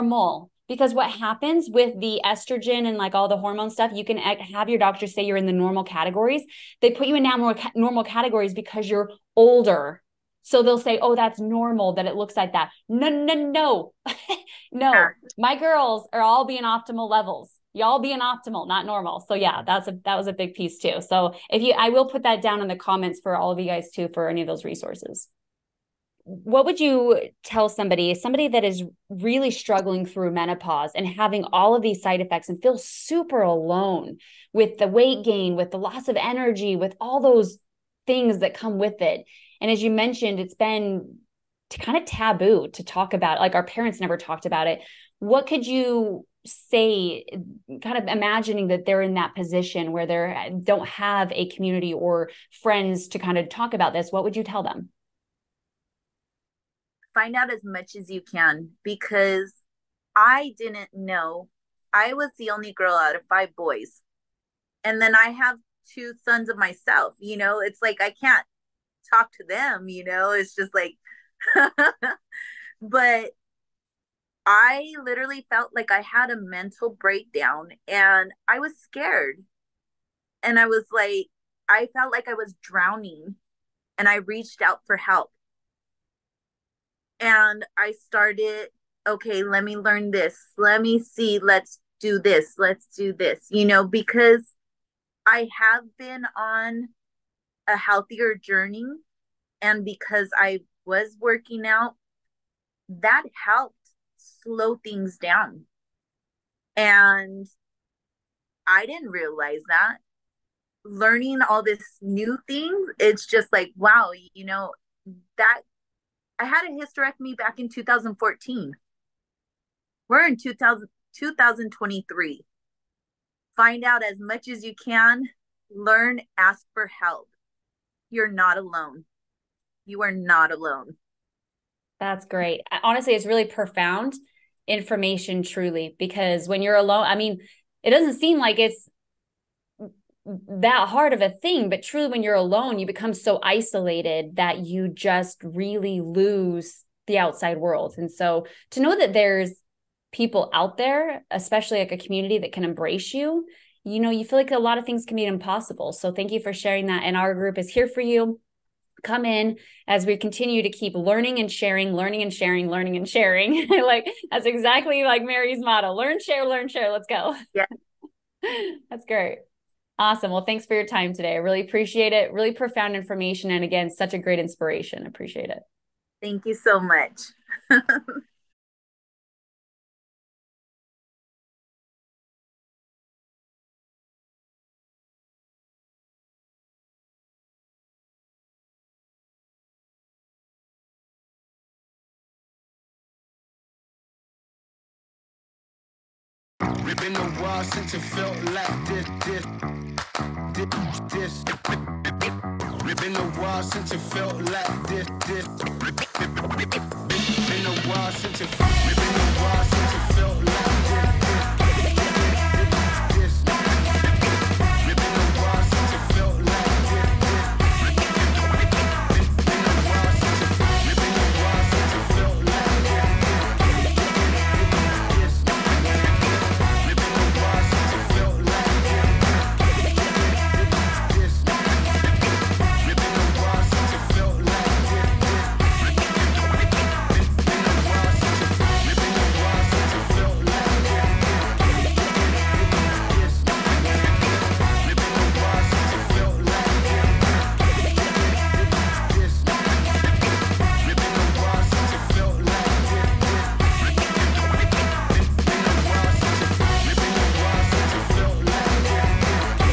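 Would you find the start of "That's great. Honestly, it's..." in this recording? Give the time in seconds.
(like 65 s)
131 s.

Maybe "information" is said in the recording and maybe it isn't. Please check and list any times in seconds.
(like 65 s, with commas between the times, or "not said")
134 s, 172 s.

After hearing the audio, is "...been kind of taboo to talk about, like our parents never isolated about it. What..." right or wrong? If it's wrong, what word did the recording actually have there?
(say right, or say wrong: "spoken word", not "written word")
wrong: "talked", not "isolated".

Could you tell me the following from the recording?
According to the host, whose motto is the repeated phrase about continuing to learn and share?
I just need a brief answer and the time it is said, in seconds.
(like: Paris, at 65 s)
Mary, at 165 s.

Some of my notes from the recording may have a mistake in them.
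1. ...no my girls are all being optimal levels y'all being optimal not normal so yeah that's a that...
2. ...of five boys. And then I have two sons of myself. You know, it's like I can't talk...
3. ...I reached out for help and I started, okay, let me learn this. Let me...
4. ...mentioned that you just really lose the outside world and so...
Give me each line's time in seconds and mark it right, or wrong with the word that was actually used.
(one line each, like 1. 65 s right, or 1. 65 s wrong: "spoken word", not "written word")
1. 14 s right
2. 63 s right
3. 84 s right
4. 143 s wrong: "isolated", not "mentioned".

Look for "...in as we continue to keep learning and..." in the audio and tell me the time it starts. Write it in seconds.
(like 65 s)
159 s.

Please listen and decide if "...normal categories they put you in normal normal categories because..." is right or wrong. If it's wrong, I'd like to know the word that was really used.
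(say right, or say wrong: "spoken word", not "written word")
right.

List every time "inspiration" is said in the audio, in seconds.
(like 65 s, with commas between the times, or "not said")
174 s.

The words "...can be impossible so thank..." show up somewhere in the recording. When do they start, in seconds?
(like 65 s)
155 s.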